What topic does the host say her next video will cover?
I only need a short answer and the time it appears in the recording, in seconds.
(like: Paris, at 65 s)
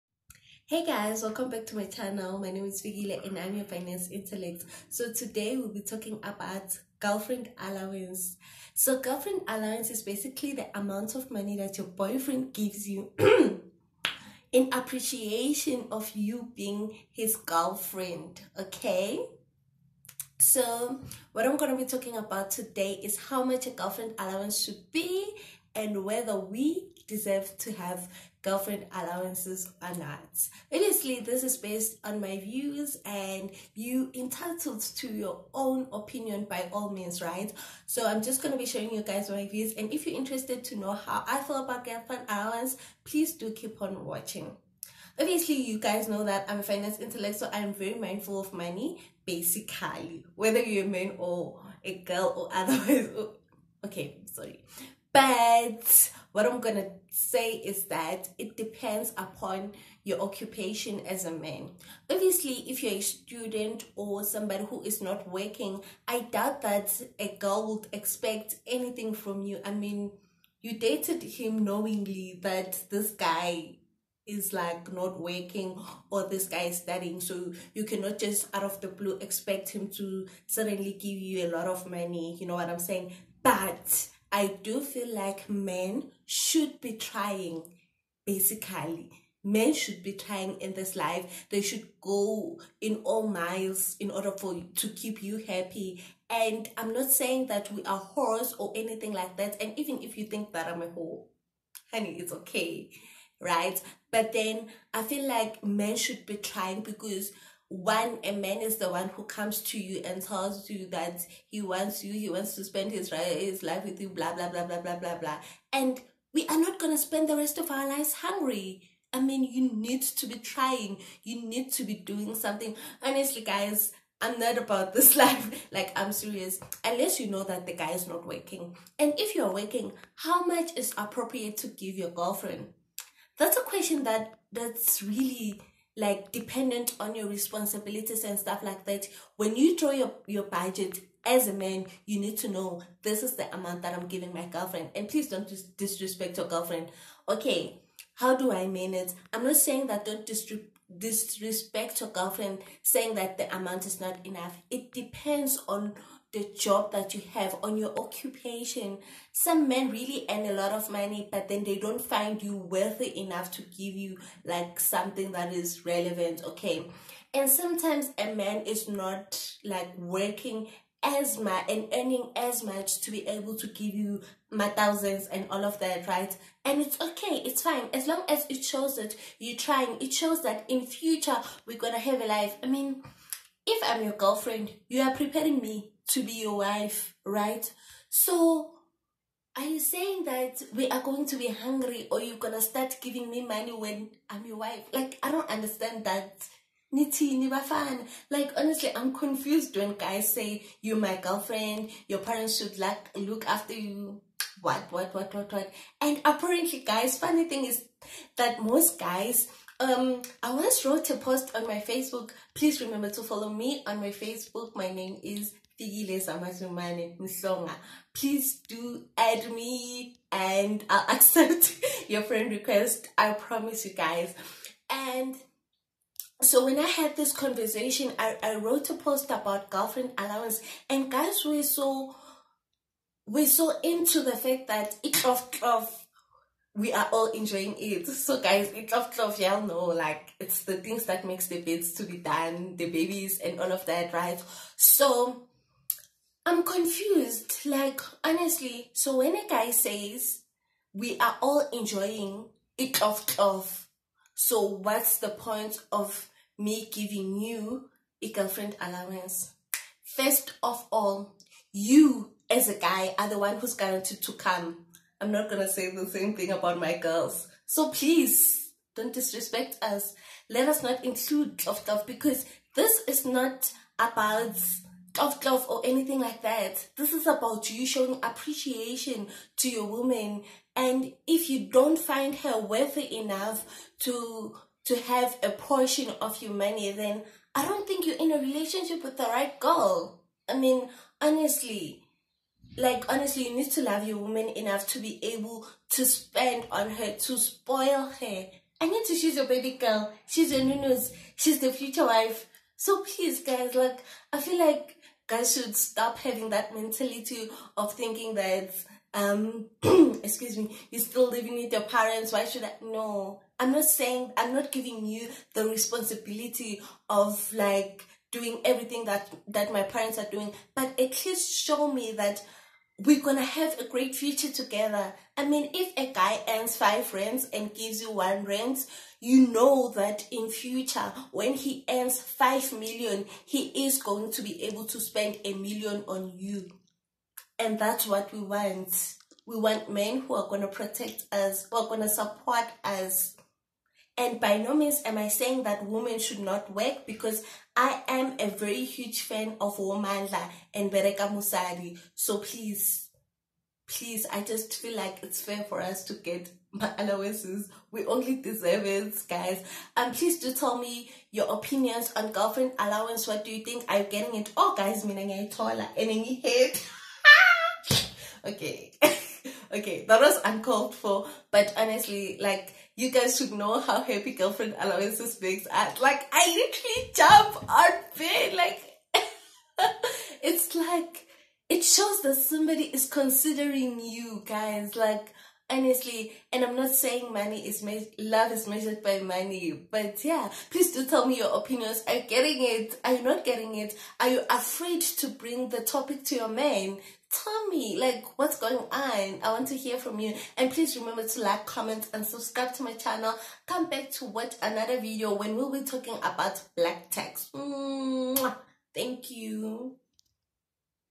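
black text, at 406 s.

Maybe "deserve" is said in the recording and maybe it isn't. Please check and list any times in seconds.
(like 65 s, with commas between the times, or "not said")
27 s, 358 s.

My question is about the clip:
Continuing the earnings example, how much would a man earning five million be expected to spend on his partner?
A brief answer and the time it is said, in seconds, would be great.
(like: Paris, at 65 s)
a million, at 335 s.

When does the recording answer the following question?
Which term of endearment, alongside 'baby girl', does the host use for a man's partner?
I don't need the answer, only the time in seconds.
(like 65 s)
300 s.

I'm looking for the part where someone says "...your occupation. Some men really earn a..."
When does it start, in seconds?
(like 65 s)
157 s.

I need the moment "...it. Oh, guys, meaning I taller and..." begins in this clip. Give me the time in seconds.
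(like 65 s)
364 s.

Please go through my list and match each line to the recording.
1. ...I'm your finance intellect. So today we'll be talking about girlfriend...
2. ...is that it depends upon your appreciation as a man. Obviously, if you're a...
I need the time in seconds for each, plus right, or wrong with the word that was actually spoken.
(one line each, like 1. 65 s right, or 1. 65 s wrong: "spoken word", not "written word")
1. 3 s right
2. 57 s wrong: "occupation", not "appreciation".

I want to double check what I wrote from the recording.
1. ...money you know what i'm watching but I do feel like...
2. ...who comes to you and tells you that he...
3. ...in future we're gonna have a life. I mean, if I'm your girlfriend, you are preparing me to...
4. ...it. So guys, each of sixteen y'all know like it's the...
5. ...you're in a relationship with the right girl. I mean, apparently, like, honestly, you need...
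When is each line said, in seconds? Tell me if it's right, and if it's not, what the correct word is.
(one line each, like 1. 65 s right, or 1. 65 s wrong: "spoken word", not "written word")
1. 81 s wrong: "saying", not "watching"
2. 109 s right
3. 180 s right
4. 237 s wrong: "twelve", not "sixteen"
5. 288 s wrong: "honestly", not "apparently".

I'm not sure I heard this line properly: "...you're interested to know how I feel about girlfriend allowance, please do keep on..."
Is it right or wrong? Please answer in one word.
right.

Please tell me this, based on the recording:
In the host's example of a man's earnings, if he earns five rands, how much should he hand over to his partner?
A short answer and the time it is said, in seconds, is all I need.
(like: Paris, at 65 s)
1 rand, at 328 s.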